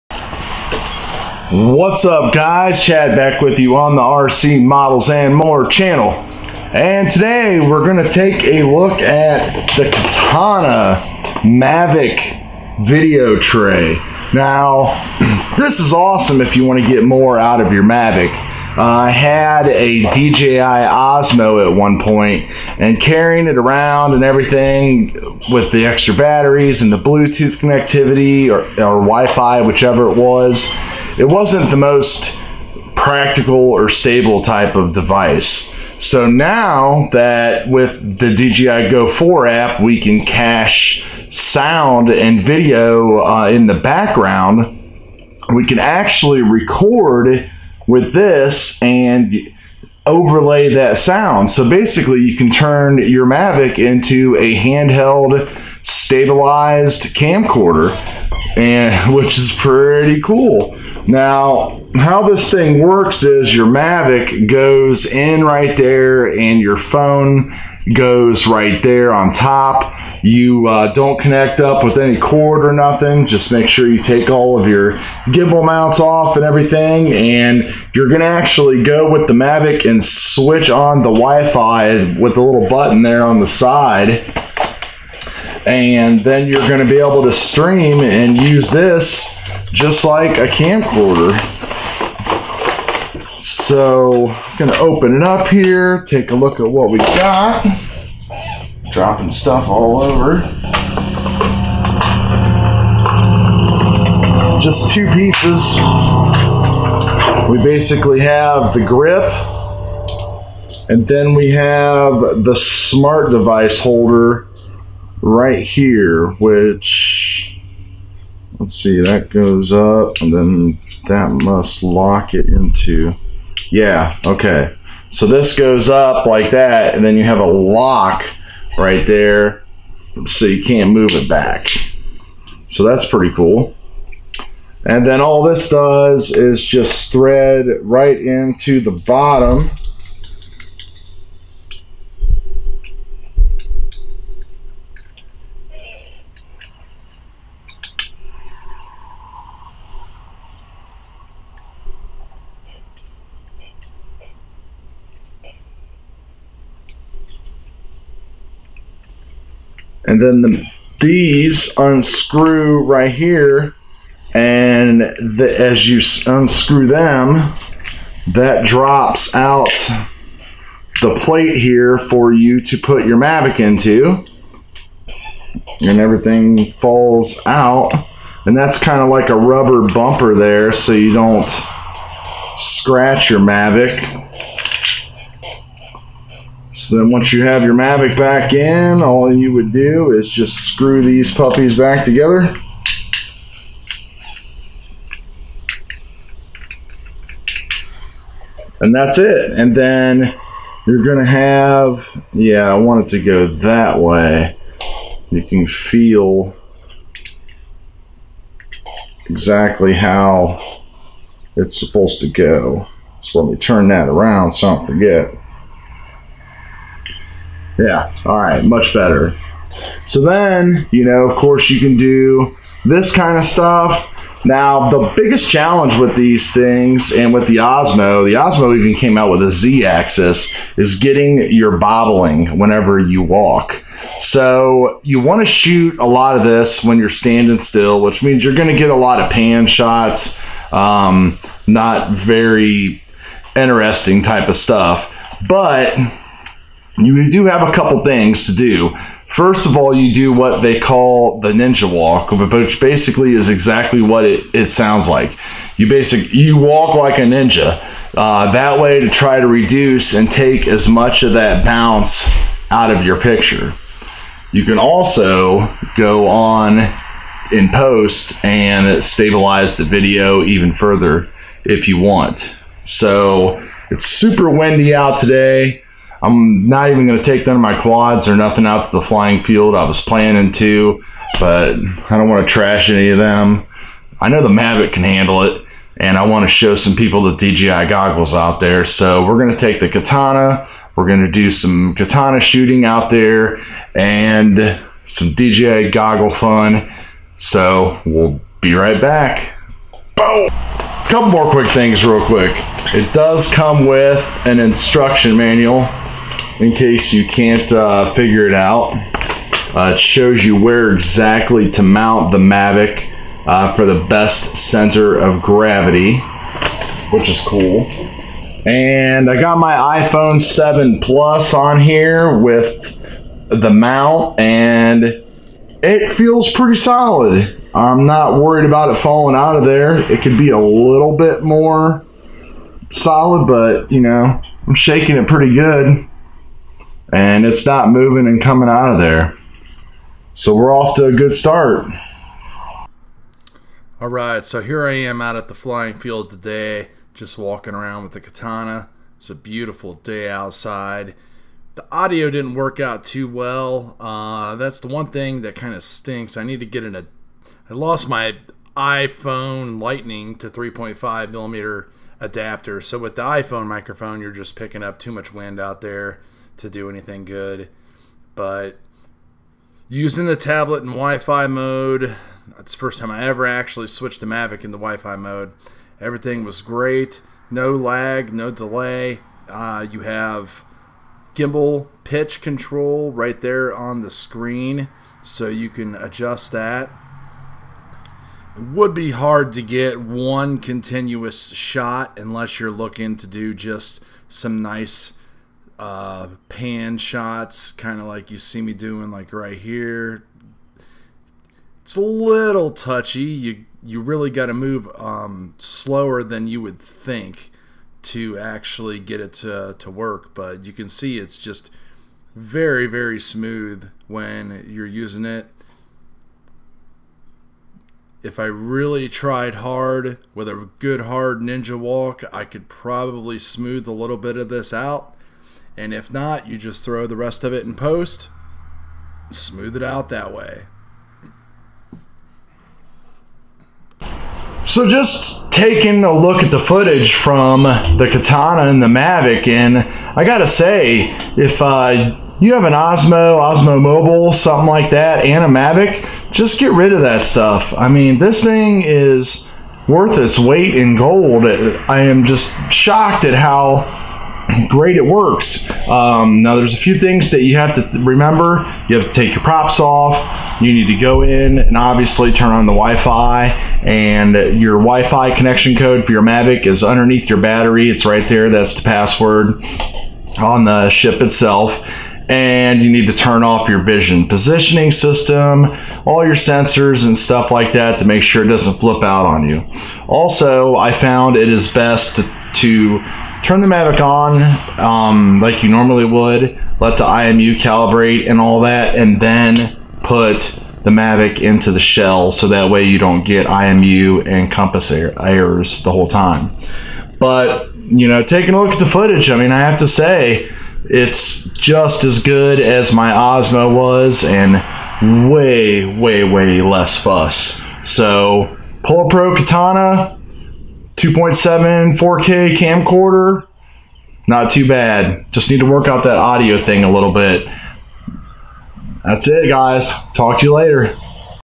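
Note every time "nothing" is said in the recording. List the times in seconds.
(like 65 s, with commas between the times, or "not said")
72 s, 278 s.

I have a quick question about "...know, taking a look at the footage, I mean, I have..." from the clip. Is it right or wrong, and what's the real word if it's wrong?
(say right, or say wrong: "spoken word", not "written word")
right.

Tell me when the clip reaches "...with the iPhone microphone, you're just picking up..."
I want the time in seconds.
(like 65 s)
362 s.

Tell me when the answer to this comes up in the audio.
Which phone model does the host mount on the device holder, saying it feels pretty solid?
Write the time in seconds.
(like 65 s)
320 s.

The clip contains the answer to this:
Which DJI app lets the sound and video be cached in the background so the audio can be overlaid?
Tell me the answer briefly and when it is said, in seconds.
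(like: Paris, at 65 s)
DJI Go 4, at 38 s.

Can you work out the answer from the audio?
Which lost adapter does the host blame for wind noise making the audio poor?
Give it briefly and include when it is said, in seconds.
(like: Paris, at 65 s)
Lightning to 3.5mm adapter, at 359 s.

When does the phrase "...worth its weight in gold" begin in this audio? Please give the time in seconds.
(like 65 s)
449 s.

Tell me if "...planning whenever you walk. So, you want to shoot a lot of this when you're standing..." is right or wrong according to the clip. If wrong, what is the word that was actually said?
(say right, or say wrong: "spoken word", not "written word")
wrong: "bobbling", not "planning".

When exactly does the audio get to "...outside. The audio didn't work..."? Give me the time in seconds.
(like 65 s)
350 s.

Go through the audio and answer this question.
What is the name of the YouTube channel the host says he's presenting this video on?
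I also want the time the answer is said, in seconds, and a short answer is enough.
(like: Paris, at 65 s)
RC Models and More, at 4 s.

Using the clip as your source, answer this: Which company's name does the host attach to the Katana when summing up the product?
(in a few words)
Polar Pro.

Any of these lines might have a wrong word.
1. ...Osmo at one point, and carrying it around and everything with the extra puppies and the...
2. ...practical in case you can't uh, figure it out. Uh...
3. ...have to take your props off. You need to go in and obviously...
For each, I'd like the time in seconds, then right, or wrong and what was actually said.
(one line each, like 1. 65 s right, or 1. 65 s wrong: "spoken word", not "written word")
1. 20 s wrong: "batteries", not "puppies"
2. 305 s wrong: "manual", not "practical"
3. 458 s right.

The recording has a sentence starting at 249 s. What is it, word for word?
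First of all, you do what they call the ninja walk, which basically is exactly what it, it sounds like.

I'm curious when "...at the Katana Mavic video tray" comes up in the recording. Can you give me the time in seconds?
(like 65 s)
9 s.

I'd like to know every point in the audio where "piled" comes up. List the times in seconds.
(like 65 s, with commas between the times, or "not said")
not said.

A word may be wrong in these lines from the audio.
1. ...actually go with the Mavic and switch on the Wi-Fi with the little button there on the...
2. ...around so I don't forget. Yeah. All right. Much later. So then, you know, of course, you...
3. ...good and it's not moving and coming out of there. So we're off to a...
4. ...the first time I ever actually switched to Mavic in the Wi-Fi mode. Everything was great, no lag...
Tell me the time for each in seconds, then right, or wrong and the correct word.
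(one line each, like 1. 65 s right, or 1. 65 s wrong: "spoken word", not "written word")
1. 78 s right
2. 214 s wrong: "better", not "later"
3. 335 s right
4. 372 s right.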